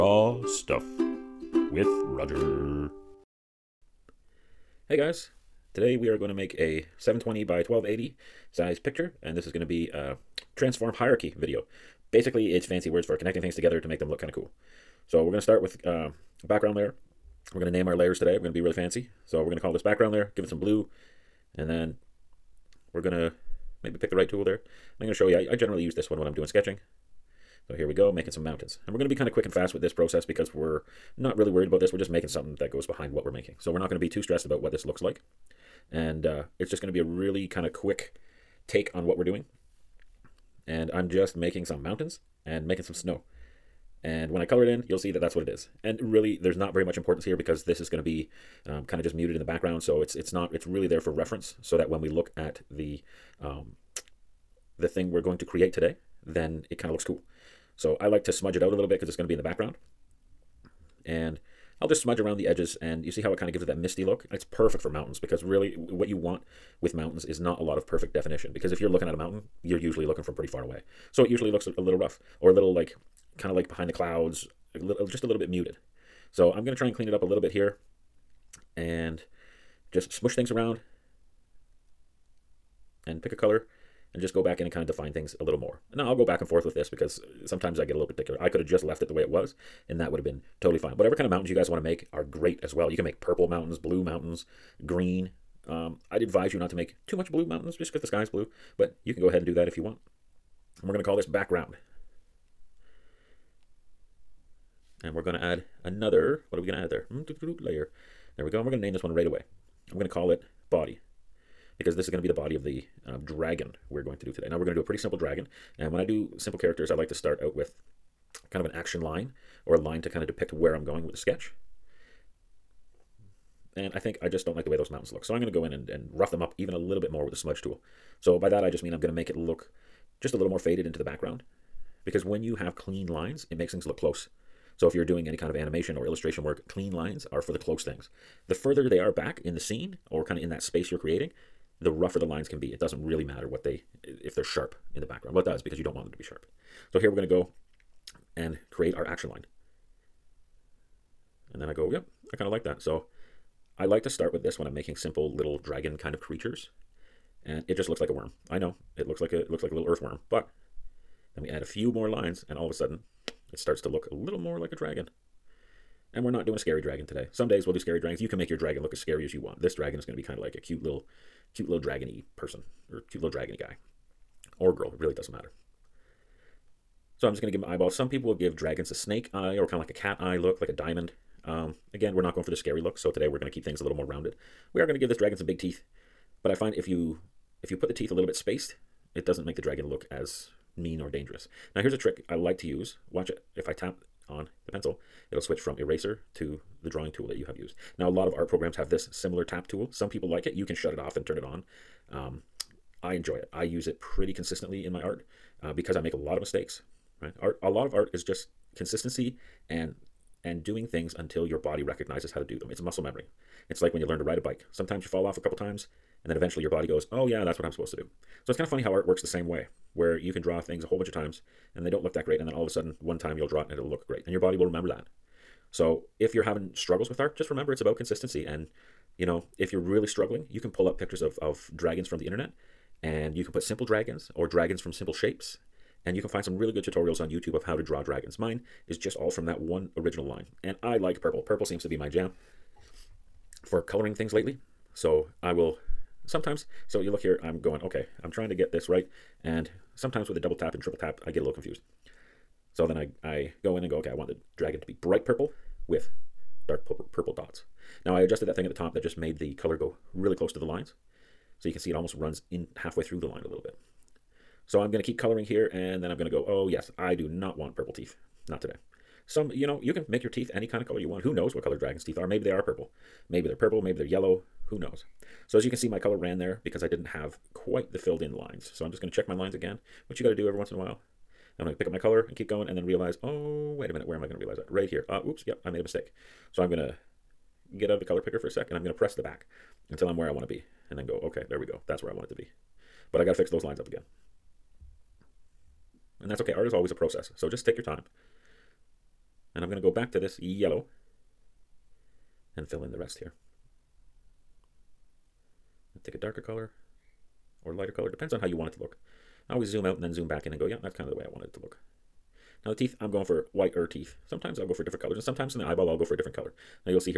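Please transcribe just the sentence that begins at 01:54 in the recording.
Now we're going to do a pretty simple dragon.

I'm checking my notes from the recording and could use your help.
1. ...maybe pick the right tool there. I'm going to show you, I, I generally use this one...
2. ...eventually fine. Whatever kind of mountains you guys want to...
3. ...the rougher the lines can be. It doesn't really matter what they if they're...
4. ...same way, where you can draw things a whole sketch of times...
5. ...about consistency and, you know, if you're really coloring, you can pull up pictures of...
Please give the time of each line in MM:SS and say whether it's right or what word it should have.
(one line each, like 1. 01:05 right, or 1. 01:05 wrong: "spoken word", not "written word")
1. 00:23 right
2. 01:30 wrong: "totally", not "eventually"
3. 02:21 right
4. 03:39 wrong: "bunch", not "sketch"
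5. 03:47 wrong: "struggling", not "coloring".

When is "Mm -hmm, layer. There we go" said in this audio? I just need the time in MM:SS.
01:47.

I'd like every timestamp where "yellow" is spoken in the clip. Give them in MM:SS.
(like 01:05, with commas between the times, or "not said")
04:34, 05:00.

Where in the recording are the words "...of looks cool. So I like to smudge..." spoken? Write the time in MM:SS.
00:56.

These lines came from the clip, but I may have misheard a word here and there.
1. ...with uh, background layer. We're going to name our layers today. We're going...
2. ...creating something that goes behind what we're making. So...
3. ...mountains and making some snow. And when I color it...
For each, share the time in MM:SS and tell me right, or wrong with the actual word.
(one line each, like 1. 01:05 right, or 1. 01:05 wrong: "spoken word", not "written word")
1. 00:15 right
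2. 00:32 wrong: "making", not "creating"
3. 00:41 right.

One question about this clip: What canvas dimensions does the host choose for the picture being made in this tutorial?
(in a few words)
720 by 1280.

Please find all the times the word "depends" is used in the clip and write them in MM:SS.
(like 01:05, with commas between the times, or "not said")
05:08.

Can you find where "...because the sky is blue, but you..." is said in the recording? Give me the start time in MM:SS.
01:37.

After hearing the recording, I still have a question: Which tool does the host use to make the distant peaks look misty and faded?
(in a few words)
smudge tool.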